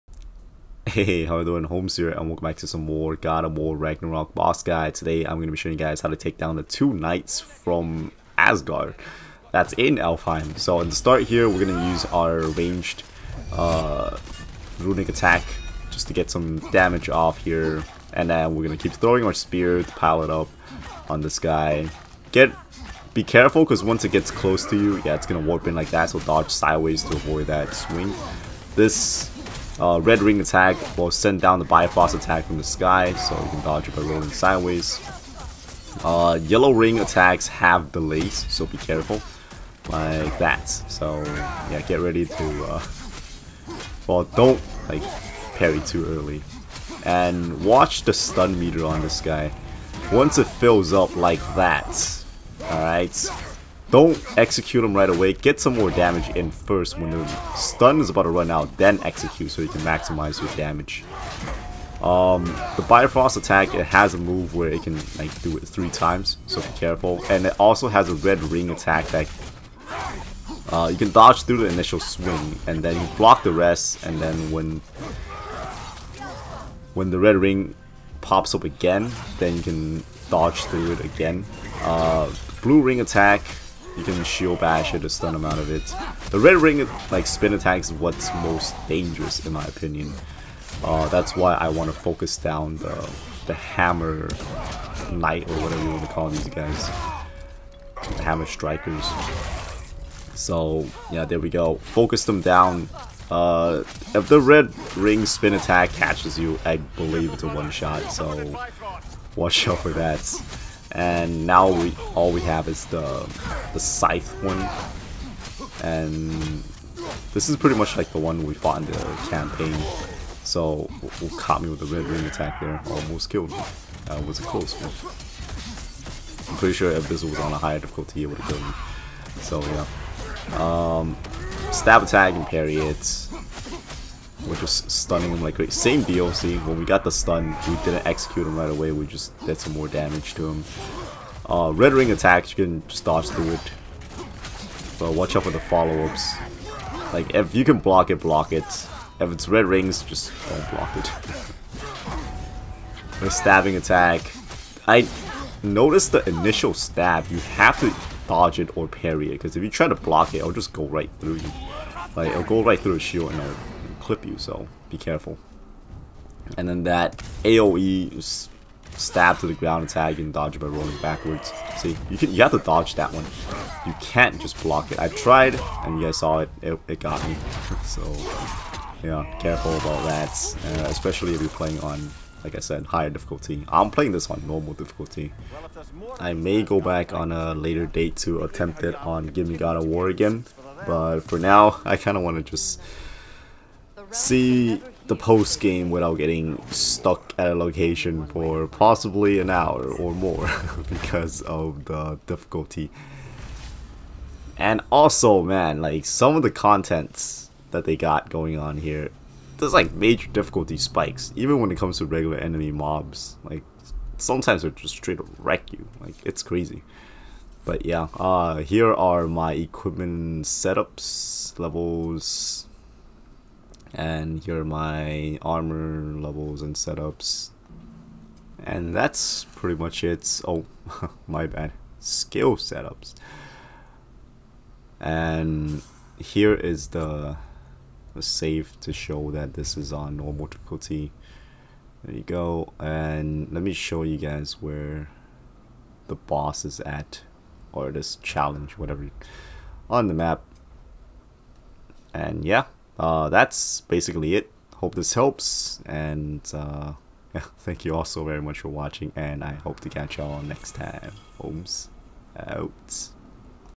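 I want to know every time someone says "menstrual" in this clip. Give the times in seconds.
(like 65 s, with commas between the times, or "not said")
not said.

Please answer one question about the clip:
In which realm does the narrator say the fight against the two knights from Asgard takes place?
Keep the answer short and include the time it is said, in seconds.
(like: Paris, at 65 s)
Alfheim, at 9 s.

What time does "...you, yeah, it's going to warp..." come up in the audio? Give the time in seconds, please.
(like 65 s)
24 s.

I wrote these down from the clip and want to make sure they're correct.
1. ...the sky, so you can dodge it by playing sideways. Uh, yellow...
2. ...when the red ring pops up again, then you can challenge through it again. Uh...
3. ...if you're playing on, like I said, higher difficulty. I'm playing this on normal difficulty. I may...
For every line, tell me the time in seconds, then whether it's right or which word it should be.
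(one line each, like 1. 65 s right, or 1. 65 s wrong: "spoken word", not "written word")
1. 32 s wrong: "rolling", not "playing"
2. 76 s wrong: "dodge", not "challenge"
3. 181 s right.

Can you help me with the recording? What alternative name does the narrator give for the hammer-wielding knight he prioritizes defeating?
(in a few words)
Hammer strikers.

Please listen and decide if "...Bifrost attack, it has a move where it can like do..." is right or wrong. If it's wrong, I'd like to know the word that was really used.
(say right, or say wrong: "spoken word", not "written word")
right.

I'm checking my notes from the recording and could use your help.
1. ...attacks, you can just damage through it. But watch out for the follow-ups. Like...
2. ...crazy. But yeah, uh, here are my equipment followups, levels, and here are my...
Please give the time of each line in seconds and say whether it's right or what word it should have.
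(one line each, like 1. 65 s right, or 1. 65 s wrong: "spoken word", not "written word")
1. 142 s wrong: "dodge", not "damage"
2. 216 s wrong: "setups", not "followups".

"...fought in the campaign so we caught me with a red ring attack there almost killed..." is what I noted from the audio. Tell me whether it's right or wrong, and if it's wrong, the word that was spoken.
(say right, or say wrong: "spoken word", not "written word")
right.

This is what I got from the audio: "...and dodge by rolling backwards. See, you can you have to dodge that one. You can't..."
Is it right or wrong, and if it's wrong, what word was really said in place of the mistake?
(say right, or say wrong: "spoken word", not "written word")
right.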